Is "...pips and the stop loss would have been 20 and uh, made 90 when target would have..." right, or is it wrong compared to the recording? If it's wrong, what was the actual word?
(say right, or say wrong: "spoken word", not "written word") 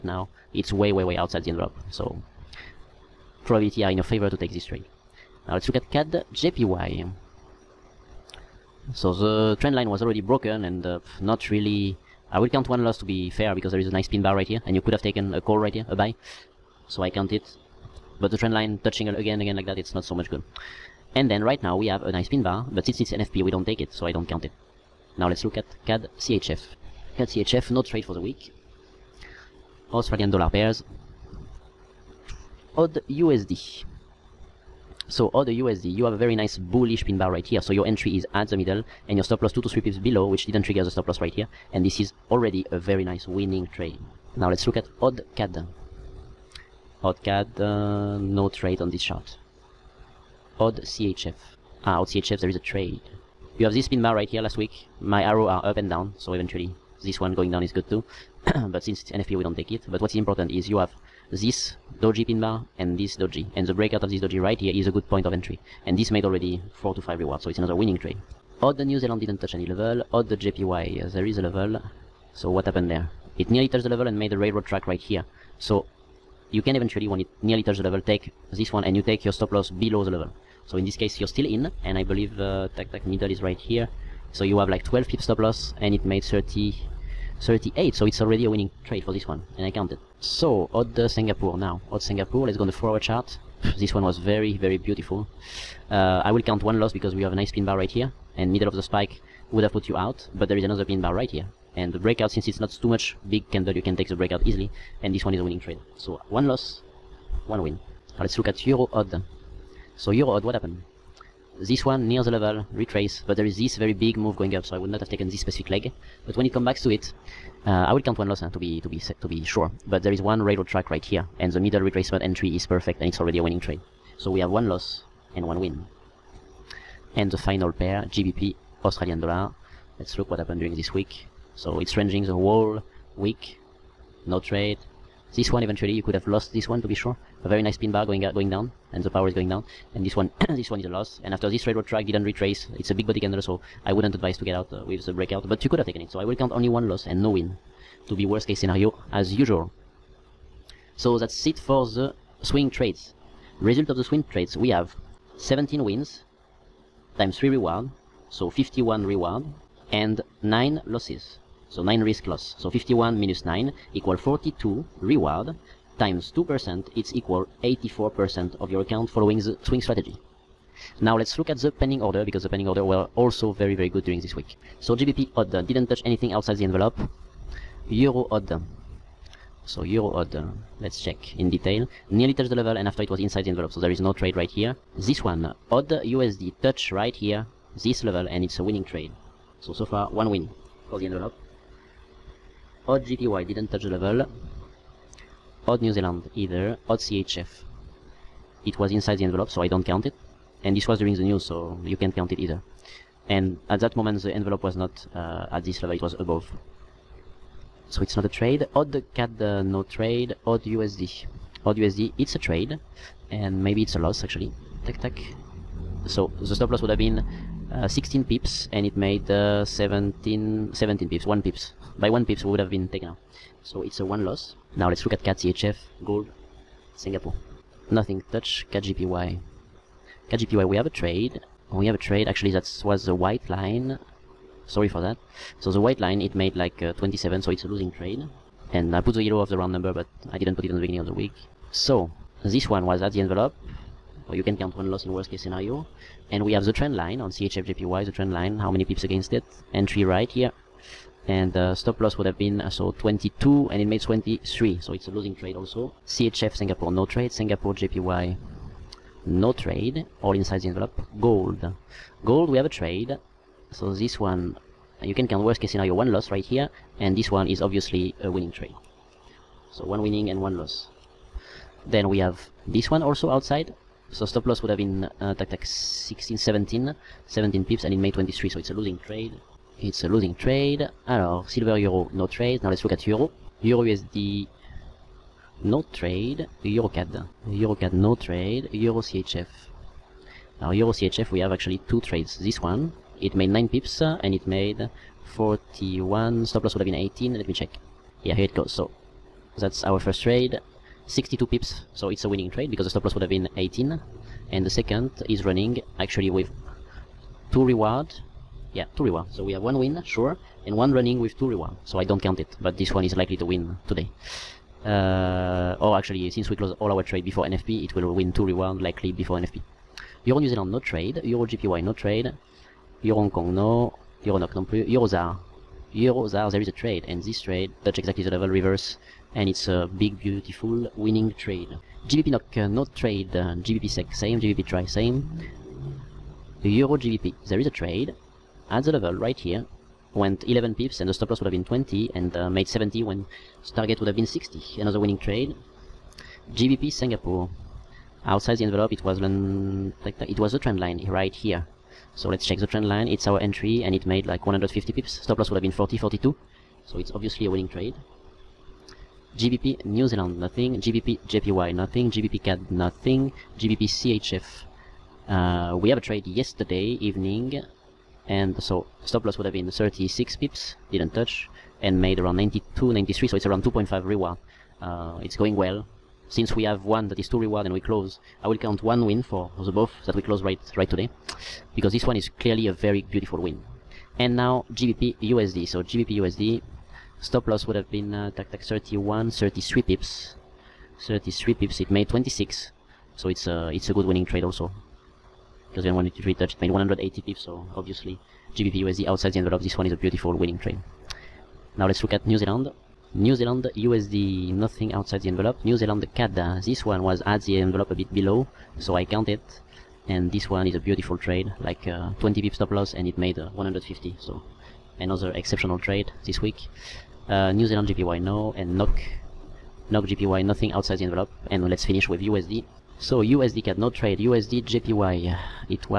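wrong: "70", not "90".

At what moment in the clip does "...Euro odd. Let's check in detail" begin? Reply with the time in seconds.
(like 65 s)
179 s.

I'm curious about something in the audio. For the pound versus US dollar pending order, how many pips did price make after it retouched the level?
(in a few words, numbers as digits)
180.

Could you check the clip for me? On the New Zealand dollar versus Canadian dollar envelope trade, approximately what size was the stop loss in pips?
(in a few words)
20.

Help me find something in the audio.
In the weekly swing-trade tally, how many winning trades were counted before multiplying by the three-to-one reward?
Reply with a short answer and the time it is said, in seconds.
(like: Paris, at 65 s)
17, at 155 s.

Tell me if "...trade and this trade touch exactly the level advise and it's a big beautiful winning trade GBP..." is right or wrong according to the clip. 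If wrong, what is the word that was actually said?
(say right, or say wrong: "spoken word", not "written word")
wrong: "reverse", not "advise".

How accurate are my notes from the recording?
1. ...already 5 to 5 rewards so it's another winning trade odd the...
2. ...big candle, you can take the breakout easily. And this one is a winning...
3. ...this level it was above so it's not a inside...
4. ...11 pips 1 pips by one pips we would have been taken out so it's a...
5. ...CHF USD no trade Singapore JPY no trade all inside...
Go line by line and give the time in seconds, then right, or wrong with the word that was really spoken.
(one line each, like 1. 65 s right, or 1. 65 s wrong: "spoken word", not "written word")
1. 66 s wrong: "4", not "5"
2. 103 s right
3. 205 s wrong: "trade", not "inside"
4. 220 s wrong: "17", not "11"
5. 256 s wrong: "Singapore", not "USD".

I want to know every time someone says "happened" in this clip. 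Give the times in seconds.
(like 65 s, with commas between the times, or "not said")
72 s, 110 s, 130 s.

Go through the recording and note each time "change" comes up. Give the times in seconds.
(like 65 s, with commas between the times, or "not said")
not said.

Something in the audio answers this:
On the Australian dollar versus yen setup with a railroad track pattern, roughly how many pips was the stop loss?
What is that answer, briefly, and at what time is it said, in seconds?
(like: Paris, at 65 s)
12, at 84 s.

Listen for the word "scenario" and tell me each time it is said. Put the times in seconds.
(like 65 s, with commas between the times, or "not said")
148 s, 245 s, 265 s.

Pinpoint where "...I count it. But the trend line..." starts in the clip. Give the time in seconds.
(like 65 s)
17 s.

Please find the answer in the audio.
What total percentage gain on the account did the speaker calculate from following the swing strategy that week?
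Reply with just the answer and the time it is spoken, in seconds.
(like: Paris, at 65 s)
84%, at 167 s.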